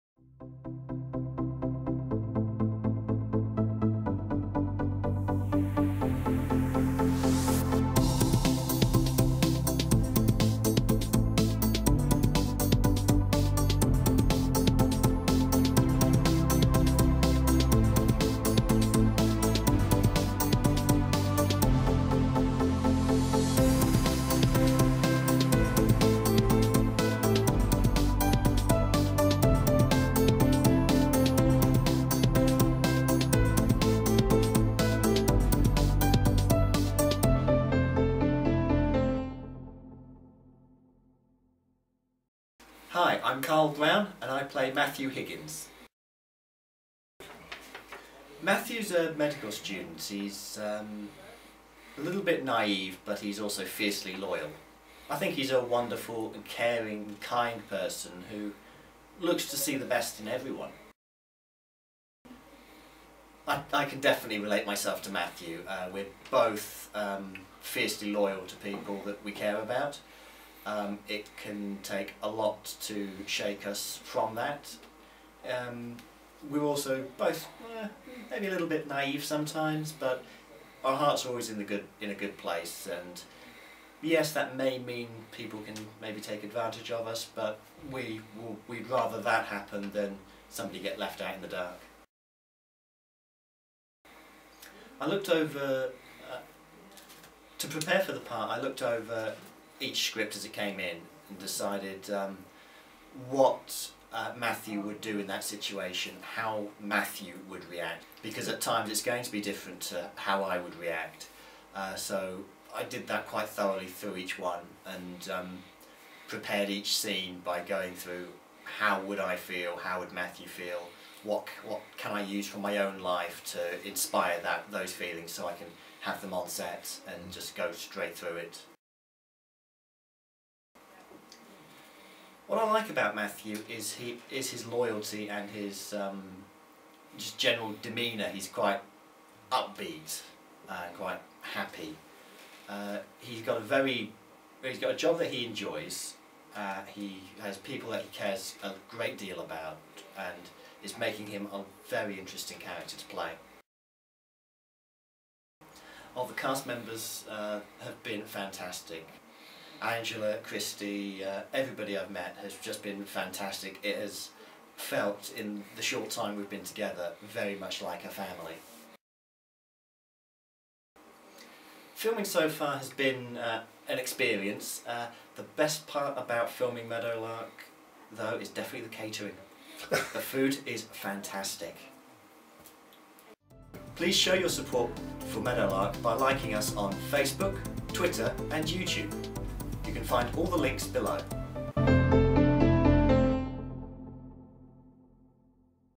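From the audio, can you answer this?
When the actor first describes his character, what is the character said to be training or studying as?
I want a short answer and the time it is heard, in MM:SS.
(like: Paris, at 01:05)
Medical student, at 00:49.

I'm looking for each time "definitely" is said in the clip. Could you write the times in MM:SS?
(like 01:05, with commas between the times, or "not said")
01:04, 02:58.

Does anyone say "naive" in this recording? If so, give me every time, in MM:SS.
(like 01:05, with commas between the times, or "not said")
00:52, 01:18.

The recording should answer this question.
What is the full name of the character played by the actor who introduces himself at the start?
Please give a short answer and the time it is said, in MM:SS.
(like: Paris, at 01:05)
Matthew Higgins, at 00:44.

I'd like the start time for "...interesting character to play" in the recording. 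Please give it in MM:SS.
02:32.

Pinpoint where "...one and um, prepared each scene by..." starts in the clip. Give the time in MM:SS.
01:54.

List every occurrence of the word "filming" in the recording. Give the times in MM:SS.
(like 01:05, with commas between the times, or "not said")
02:51, 02:56.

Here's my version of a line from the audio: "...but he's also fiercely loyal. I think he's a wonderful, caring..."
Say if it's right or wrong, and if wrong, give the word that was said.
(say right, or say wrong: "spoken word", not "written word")
right.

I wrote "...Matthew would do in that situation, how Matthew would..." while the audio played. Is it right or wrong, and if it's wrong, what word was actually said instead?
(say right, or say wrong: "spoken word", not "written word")
right.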